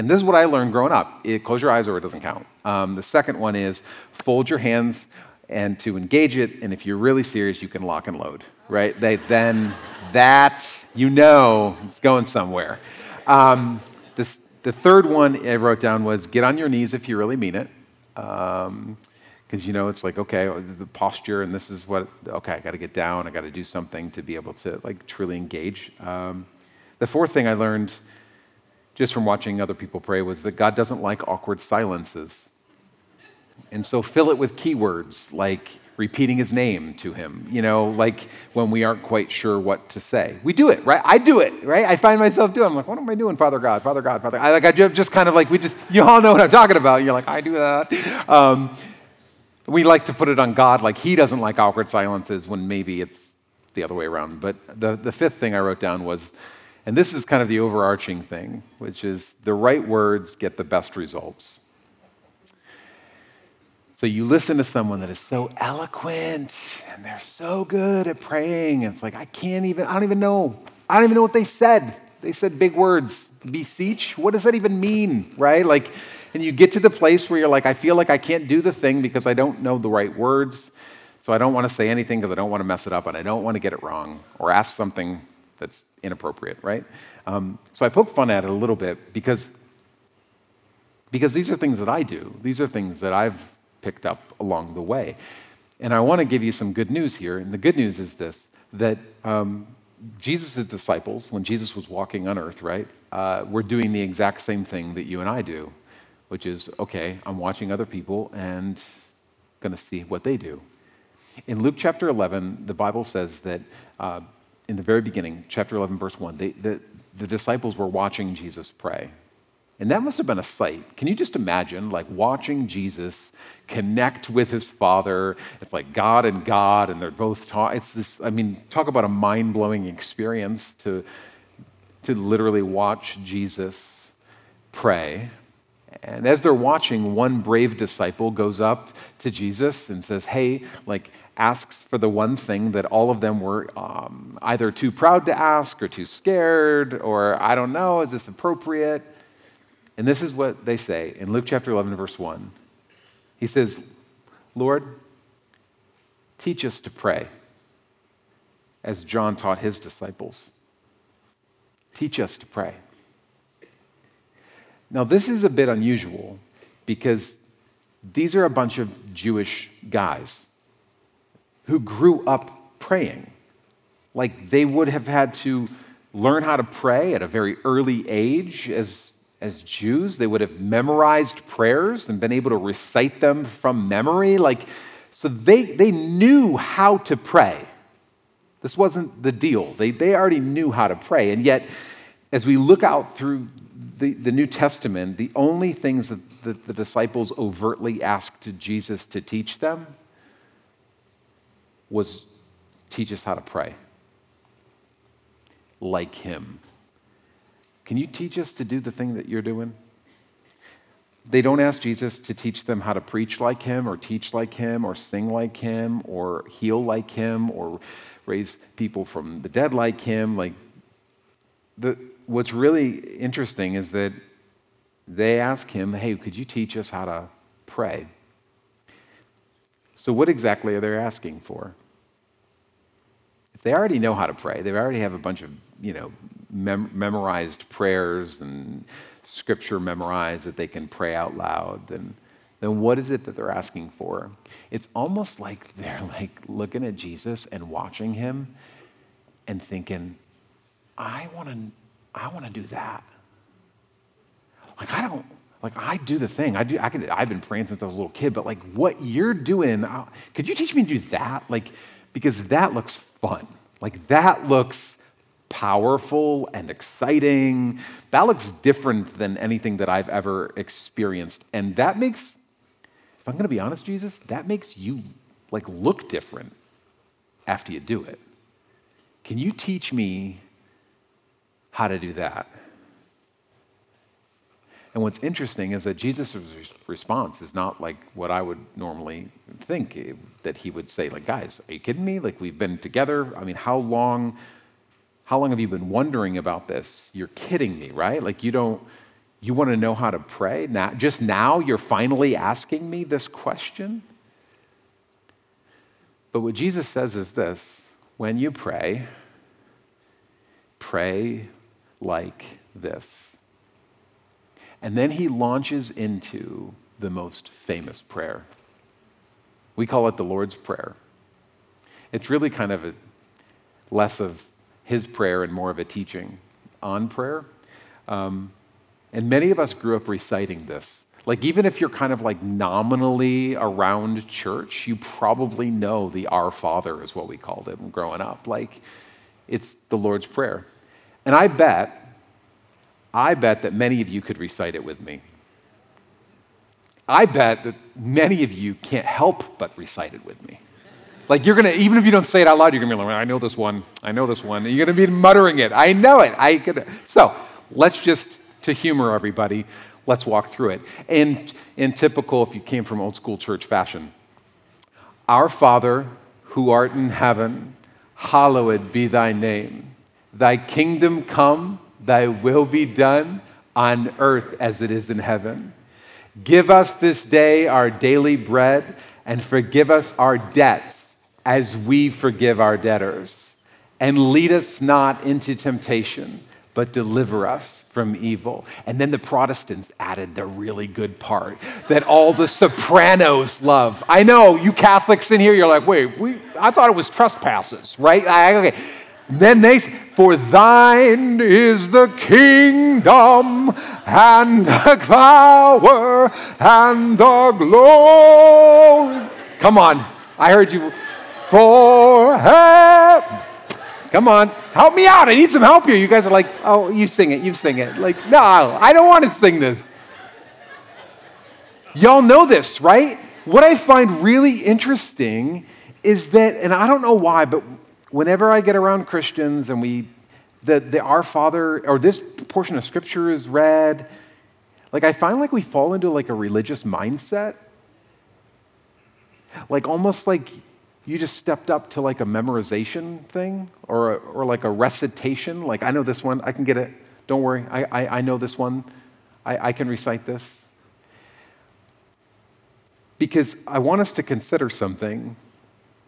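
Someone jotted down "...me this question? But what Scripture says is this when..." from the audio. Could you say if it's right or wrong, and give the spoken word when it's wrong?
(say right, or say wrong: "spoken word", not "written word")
wrong: "Jesus", not "Scripture".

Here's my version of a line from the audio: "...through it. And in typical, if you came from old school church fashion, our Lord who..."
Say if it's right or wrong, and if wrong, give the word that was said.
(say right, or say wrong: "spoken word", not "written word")
wrong: "Father", not "Lord".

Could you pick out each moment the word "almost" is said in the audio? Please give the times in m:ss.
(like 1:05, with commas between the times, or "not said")
4:04, 7:19.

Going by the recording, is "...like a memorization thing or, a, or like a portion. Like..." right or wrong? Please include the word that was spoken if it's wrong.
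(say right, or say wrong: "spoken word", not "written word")
wrong: "recitation", not "portion".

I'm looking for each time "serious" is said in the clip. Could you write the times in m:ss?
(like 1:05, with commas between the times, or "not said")
0:07.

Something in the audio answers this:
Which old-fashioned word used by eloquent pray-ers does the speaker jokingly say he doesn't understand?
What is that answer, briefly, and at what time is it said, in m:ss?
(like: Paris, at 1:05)
Beseech, at 1:13.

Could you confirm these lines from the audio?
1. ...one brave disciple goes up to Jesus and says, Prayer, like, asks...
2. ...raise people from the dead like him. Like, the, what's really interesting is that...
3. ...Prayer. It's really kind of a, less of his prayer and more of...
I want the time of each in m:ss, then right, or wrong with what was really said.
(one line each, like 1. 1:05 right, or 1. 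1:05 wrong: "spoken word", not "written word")
1. 2:17 wrong: "Hey", not "Prayer"
2. 3:38 right
3. 5:20 right.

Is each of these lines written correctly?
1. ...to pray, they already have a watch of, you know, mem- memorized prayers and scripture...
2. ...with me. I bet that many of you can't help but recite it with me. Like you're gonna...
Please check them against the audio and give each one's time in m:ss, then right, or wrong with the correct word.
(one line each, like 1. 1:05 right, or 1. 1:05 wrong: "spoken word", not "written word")
1. 3:54 wrong: "bunch", not "watch"
2. 5:44 right.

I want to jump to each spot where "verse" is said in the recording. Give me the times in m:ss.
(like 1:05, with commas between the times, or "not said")
1:55, 2:31.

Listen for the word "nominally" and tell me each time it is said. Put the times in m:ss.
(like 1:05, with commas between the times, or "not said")
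5:32.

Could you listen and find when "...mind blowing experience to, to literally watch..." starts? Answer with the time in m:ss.
2:09.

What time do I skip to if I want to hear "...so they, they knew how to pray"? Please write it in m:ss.
3:05.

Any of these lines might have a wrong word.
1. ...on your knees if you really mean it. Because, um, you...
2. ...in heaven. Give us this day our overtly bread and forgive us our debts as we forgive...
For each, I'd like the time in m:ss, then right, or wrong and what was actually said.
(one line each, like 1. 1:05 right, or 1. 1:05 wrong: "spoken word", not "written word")
1. 0:16 right
2. 6:15 wrong: "daily", not "overtly".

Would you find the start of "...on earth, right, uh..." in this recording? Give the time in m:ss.
1:42.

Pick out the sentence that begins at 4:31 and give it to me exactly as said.
And that makes, if I'm going to be honest, Jesus, that makes you like look different after you do it.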